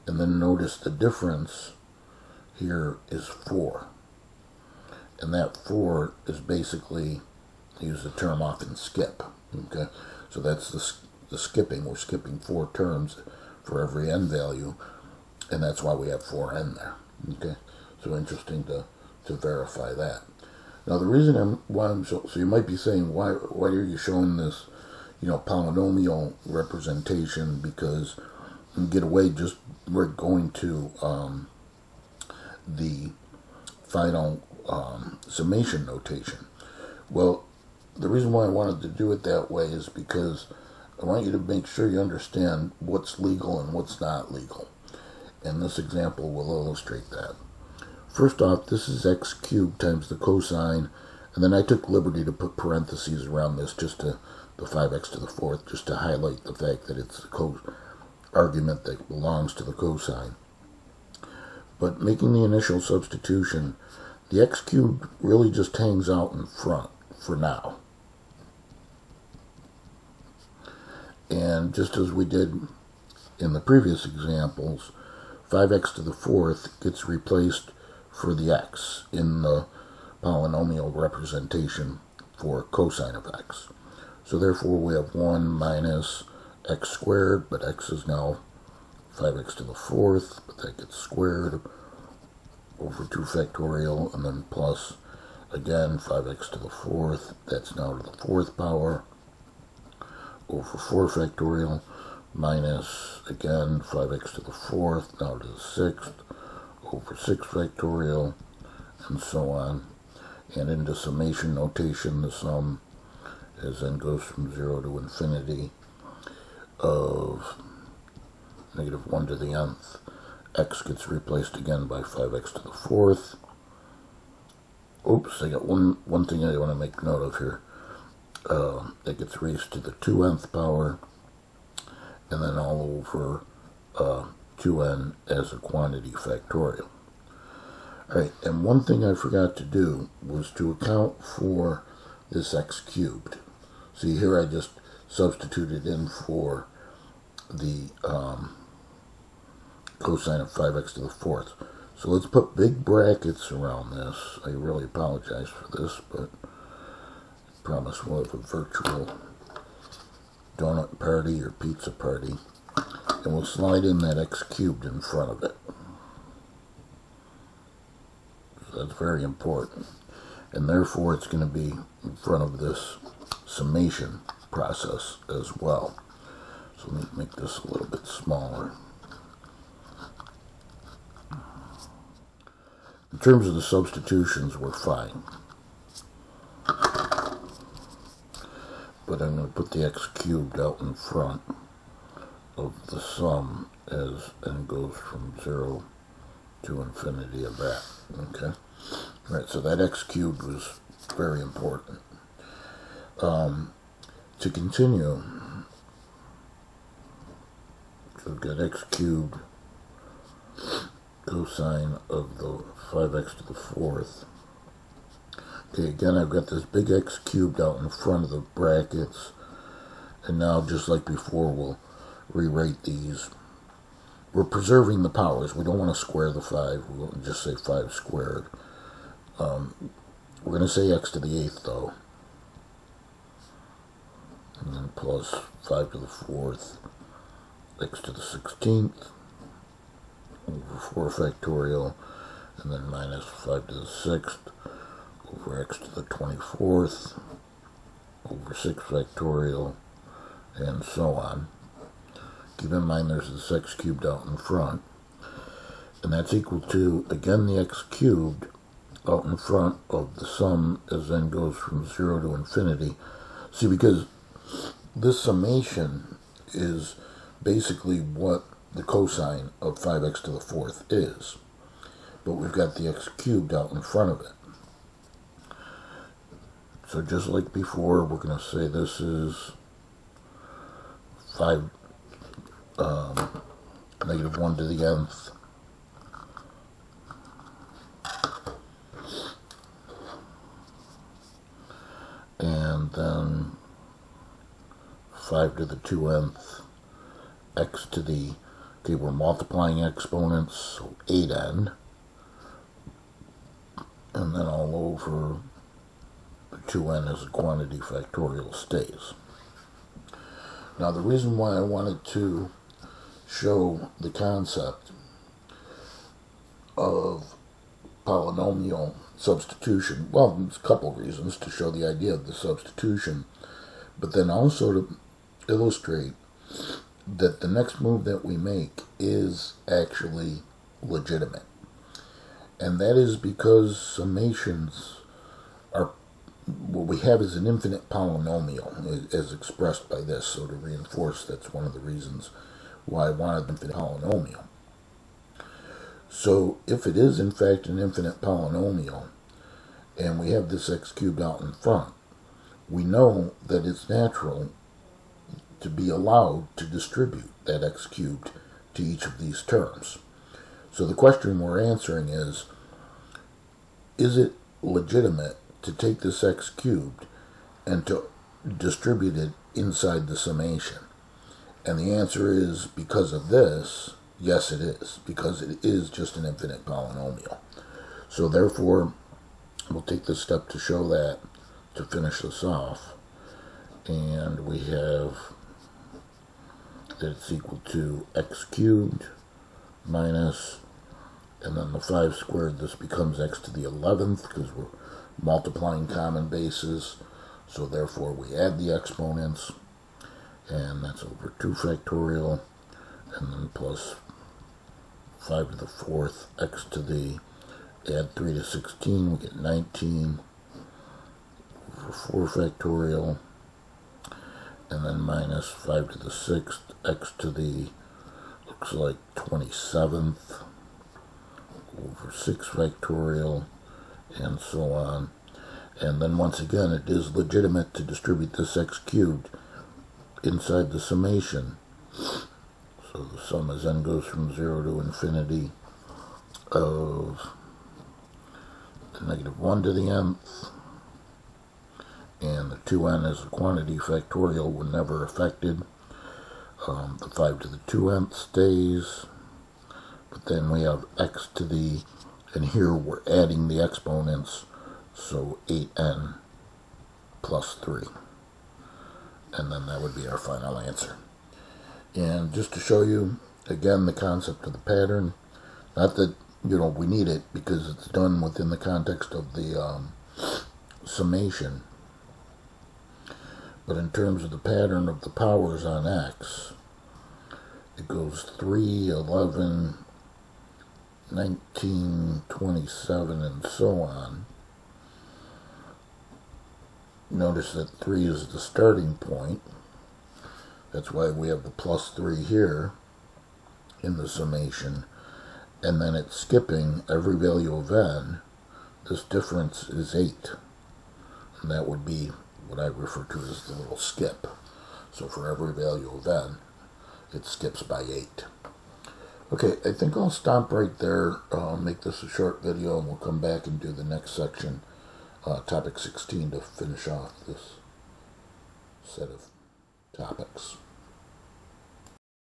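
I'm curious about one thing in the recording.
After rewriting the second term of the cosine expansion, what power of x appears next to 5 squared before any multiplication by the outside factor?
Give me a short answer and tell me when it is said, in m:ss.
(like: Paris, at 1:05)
x to the 8th, at 3:50.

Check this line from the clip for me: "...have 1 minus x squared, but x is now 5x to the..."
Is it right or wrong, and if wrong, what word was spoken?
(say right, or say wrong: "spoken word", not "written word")
right.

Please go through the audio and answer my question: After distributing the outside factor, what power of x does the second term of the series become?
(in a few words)
11.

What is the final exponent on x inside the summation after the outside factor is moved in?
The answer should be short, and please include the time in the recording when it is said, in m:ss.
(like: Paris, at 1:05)
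8n plus 3, at 7:35.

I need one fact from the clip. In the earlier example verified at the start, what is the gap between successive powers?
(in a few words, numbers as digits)
4.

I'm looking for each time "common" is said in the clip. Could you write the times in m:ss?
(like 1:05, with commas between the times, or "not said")
6:35.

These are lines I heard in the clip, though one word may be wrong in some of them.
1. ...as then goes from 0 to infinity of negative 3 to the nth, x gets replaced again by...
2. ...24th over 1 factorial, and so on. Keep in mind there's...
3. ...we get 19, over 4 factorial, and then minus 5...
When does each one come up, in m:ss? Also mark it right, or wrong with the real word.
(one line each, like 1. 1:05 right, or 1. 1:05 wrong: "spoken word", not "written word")
1. 1:53 wrong: "1", not "3"
2. 4:06 wrong: "6", not "1"
3. 6:49 right.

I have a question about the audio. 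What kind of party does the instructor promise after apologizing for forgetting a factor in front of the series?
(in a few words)
virtual donut party.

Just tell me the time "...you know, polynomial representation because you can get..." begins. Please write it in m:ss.
0:25.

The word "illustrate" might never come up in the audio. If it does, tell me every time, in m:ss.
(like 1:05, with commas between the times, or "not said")
0:46, 5:25.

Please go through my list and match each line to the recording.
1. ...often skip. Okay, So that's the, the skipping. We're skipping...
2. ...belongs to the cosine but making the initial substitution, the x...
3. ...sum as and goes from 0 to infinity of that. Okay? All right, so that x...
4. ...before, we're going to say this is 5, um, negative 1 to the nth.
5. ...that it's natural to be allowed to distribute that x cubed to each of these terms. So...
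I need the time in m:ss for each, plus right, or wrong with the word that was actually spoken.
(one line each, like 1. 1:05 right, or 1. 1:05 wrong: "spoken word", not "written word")
1. 0:08 right
2. 0:59 right
3. 3:12 right
4. 4:37 right
5. 5:53 right.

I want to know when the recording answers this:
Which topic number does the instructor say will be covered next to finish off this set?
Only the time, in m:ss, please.
8:35.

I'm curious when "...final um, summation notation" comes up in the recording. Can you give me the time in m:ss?
0:33.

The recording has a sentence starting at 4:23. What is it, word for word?
See, because this summation is basically what the cosine of 5x to the fourth is.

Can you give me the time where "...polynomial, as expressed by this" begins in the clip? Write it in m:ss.
5:37.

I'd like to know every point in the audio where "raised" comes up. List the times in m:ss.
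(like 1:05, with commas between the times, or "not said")
2:09.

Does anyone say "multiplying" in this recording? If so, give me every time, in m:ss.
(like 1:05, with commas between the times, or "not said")
4:59, 6:35.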